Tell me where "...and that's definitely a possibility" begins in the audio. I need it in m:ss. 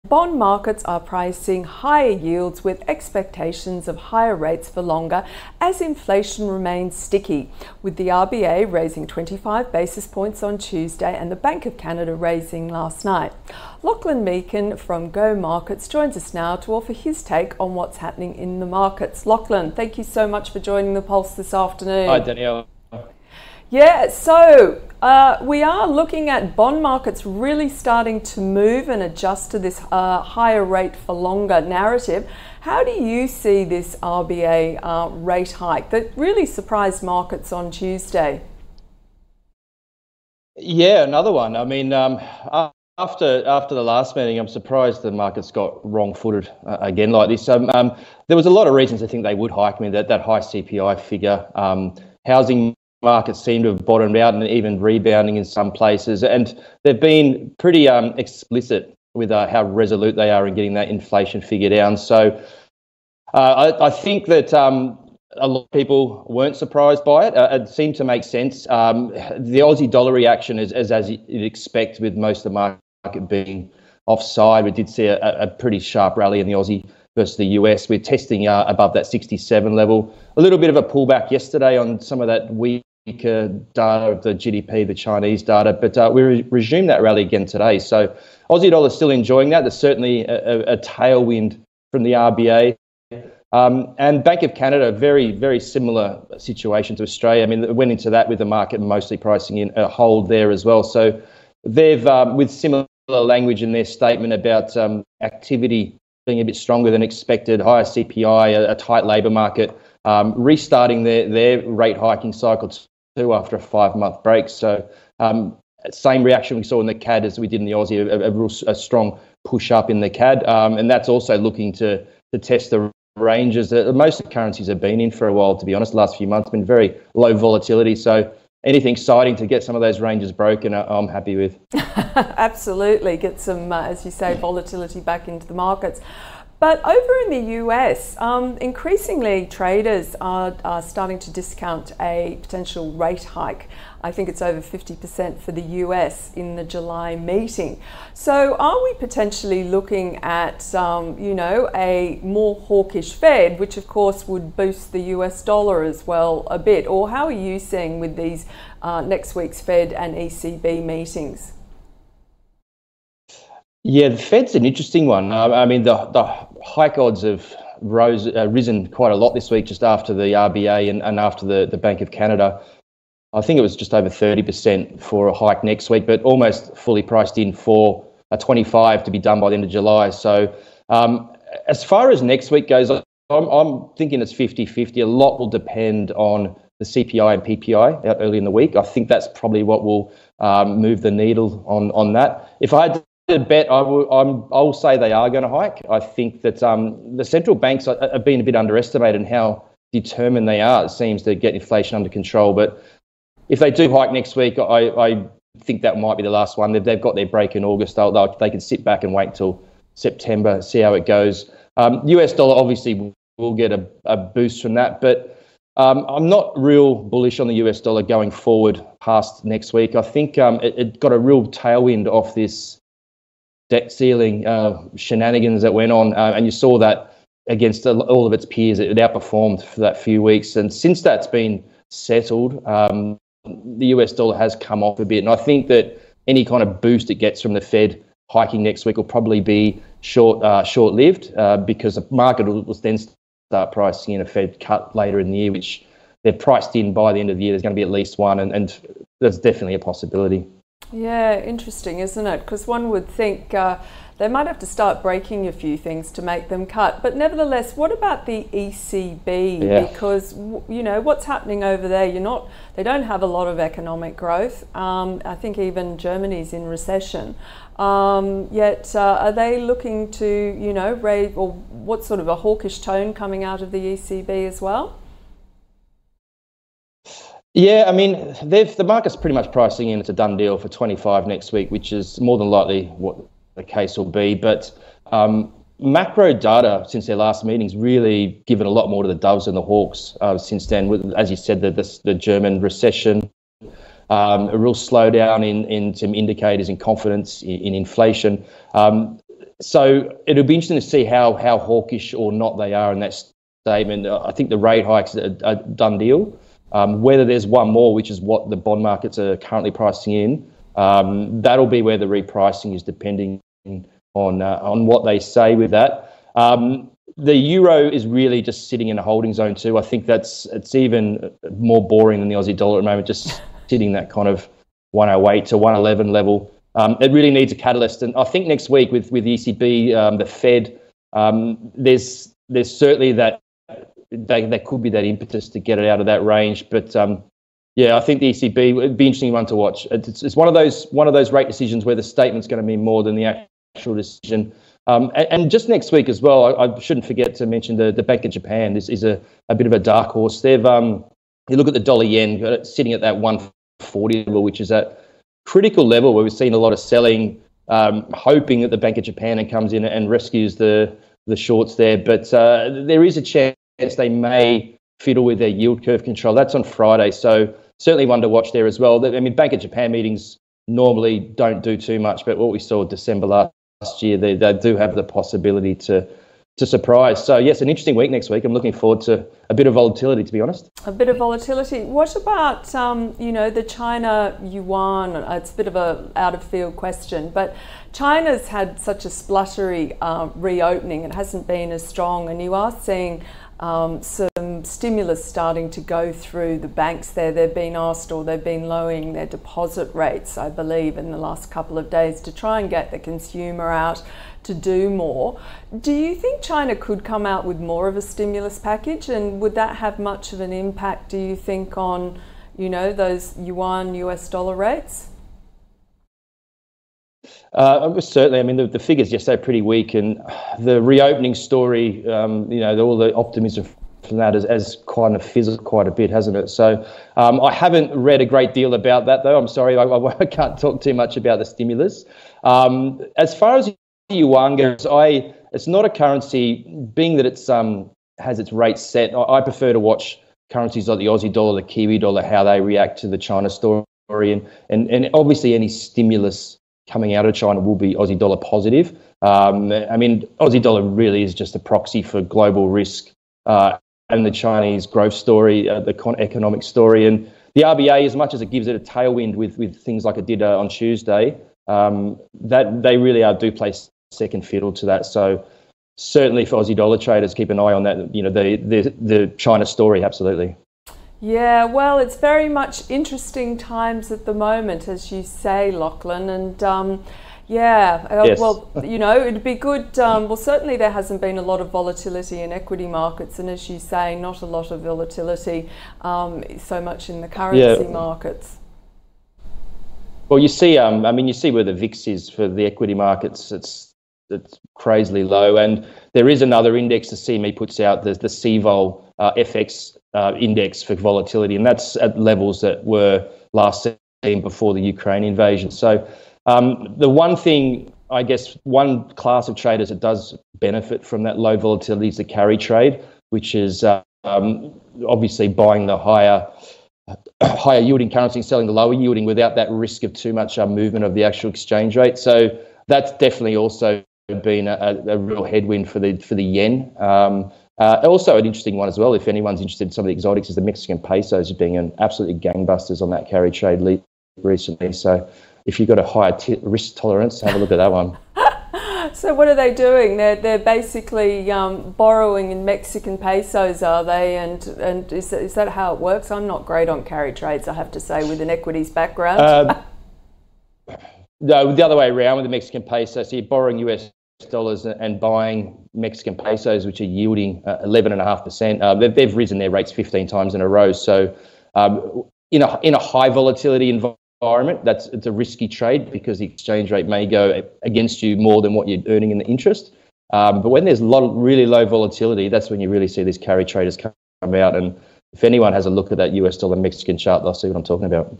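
4:08.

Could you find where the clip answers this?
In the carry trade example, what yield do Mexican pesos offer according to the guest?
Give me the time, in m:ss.
9:17.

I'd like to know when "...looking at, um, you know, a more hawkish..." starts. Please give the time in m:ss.
2:29.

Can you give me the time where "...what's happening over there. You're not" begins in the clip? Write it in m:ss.
4:20.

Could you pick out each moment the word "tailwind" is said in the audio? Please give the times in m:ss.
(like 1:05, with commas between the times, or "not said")
1:30, 3:41, 7:38.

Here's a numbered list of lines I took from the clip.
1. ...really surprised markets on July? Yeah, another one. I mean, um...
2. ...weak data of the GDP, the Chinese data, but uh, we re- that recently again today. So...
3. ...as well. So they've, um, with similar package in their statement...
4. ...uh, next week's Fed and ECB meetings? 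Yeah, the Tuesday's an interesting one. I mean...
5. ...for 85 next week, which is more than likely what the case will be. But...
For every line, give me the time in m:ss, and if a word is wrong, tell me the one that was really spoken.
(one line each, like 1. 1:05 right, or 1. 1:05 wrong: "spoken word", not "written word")
1. 0:36 wrong: "Tuesday", not "July"
2. 1:22 wrong: "rally", not "recently"
3. 1:40 wrong: "language", not "package"
4. 2:38 wrong: "Fed", not "Tuesday"
5. 4:40 wrong: "25", not "85".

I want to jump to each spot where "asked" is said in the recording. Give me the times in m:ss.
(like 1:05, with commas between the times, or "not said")
6:37.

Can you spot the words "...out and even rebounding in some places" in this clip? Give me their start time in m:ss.
0:54.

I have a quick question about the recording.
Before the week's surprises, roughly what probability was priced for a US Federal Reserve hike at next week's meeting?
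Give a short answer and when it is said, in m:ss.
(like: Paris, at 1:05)
just over 30%, at 2:53.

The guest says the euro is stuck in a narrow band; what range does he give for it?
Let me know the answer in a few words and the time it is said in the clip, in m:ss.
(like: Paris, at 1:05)
108 to 111, at 5:24.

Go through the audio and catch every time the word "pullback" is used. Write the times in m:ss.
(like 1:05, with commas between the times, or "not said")
1:20.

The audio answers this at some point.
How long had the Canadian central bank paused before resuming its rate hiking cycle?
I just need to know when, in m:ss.
1:53.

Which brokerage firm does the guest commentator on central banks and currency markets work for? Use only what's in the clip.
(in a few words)
Go Markets.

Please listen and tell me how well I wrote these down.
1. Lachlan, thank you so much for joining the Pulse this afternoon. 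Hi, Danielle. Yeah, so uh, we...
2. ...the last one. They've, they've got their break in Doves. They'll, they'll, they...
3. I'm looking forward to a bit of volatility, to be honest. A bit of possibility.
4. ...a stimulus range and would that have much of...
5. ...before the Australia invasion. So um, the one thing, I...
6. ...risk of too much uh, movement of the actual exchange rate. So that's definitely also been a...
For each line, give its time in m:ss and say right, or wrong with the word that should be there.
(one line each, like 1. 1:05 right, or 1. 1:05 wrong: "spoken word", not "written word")
1. 0:19 right
2. 3:26 wrong: "August", not "Doves"
3. 6:18 wrong: "volatility", not "possibility"
4. 6:47 wrong: "package", not "range"
5. 8:24 wrong: "Ukraine", not "Australia"
6. 8:39 right.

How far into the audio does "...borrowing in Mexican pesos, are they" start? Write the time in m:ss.
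9:01.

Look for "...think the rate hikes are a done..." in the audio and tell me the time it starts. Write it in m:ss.
5:04.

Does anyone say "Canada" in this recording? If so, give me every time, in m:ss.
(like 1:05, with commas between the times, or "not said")
0:11, 1:34, 2:52.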